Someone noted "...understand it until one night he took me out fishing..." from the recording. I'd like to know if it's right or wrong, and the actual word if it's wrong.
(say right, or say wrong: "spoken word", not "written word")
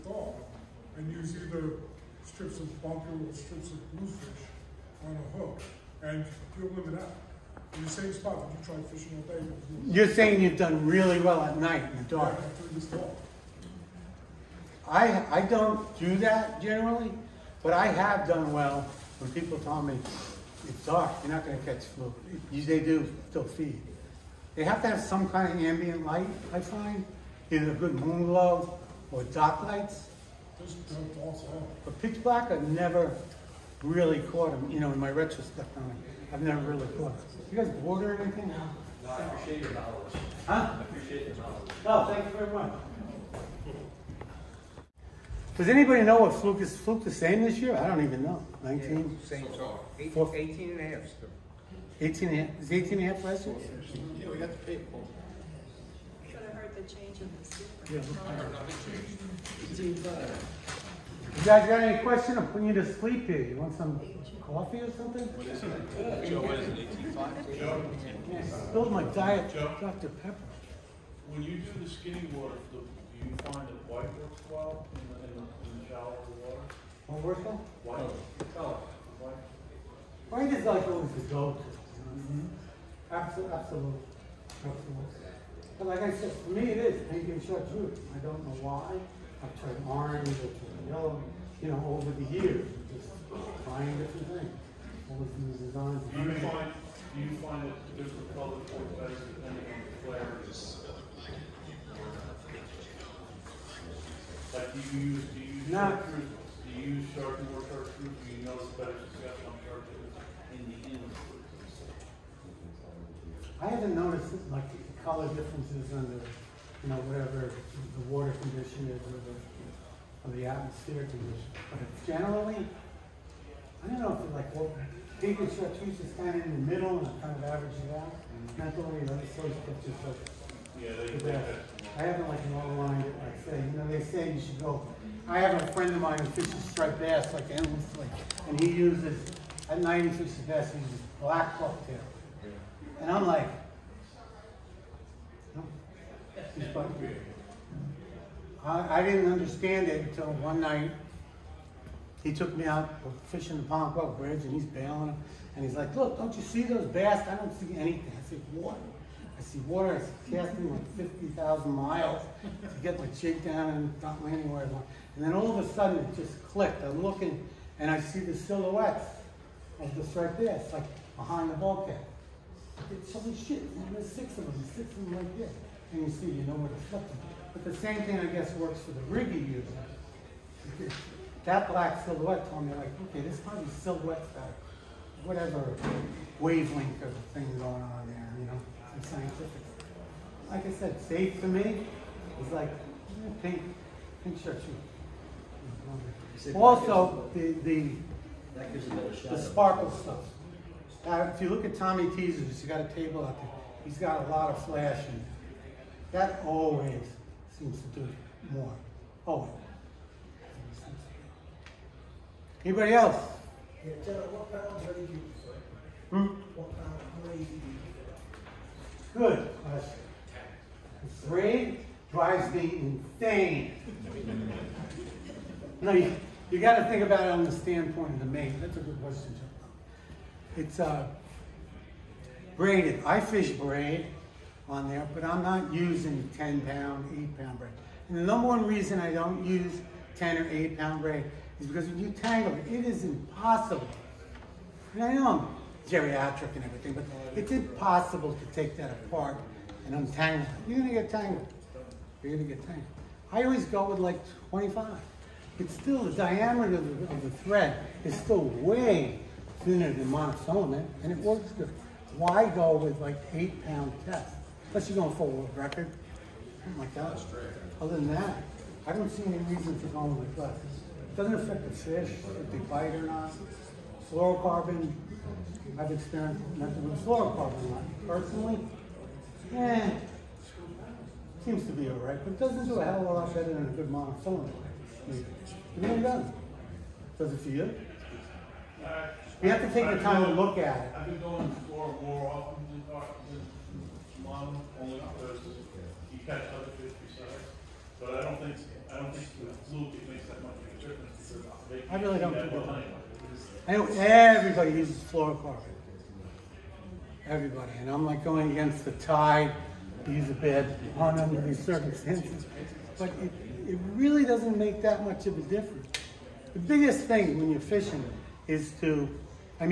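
right.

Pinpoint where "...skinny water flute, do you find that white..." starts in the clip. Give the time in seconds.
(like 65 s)
71 s.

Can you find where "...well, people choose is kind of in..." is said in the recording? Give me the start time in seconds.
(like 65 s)
124 s.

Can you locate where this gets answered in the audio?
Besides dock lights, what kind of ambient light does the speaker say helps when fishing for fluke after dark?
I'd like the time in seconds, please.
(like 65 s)
27 s.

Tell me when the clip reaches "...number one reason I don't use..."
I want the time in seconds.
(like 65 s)
238 s.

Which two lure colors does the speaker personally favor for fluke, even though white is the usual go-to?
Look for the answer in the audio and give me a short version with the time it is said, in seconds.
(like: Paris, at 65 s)
pink and chartreuse, at 87 s.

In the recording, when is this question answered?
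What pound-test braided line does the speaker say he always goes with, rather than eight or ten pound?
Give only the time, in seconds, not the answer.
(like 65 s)
254 s.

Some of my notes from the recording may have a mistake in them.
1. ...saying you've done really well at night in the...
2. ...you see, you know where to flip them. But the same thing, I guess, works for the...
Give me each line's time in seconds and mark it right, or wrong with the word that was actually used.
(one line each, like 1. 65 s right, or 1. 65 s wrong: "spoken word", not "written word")
1. 10 s right
2. 176 s right.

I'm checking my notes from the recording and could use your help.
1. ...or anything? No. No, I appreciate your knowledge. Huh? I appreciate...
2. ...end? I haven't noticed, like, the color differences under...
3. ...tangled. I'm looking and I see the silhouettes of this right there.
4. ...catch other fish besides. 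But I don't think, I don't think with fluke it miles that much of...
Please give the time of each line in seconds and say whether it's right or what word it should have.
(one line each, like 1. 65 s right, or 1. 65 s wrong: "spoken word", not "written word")
1. 38 s right
2. 110 s right
3. 166 s wrong: "clicked", not "tangled"
4. 296 s wrong: "makes", not "miles".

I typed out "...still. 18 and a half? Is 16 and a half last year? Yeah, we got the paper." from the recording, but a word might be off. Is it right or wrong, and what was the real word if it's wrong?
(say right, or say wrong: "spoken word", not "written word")
wrong: "18", not "16".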